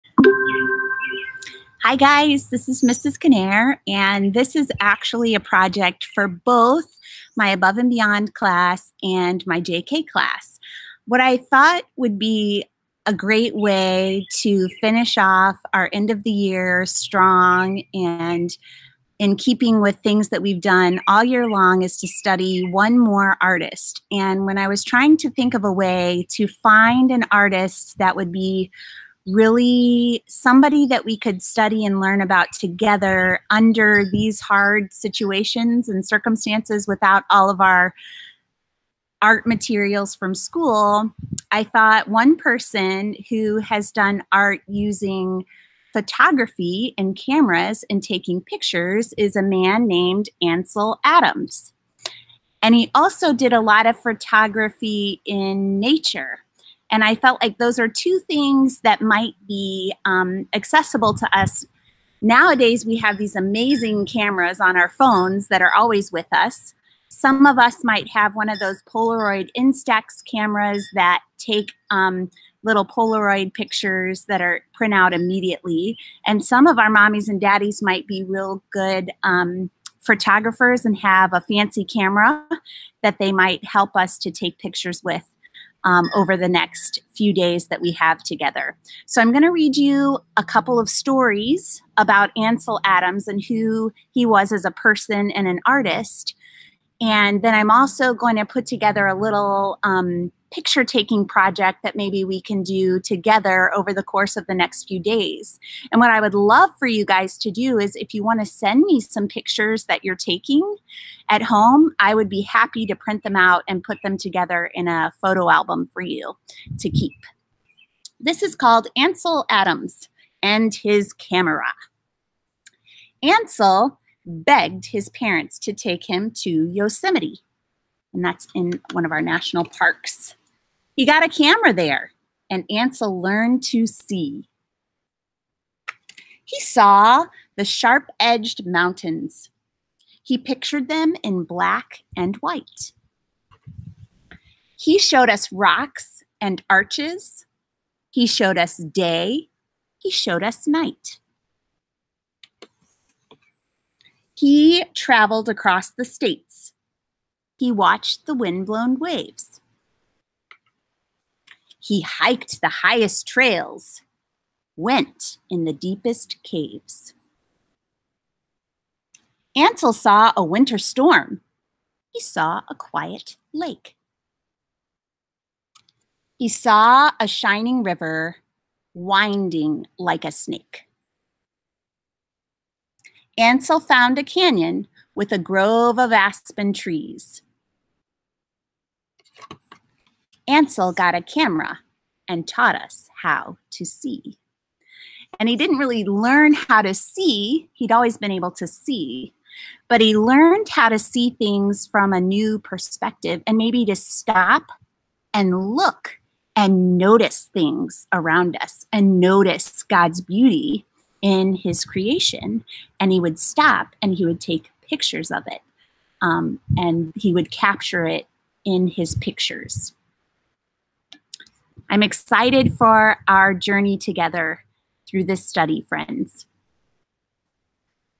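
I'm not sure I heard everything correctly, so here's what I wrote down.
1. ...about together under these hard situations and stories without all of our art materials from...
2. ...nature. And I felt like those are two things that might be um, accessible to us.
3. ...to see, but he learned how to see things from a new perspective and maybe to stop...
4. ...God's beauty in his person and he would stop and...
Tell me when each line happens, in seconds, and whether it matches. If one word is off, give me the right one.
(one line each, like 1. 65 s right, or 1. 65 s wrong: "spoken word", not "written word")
1. 32 s wrong: "circumstances", not "stories"
2. 55 s right
3. 198 s right
4. 209 s wrong: "creation", not "person".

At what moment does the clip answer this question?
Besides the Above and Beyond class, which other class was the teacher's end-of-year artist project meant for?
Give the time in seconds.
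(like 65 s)
9 s.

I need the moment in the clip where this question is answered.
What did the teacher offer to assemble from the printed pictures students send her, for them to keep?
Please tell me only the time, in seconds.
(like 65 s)
115 s.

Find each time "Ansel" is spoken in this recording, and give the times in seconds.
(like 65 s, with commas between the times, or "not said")
50 s, 92 s, 118 s, 123 s, 132 s, 169 s, 183 s, 190 s.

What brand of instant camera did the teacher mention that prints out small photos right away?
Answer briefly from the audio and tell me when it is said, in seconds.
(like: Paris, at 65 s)
Instax, at 69 s.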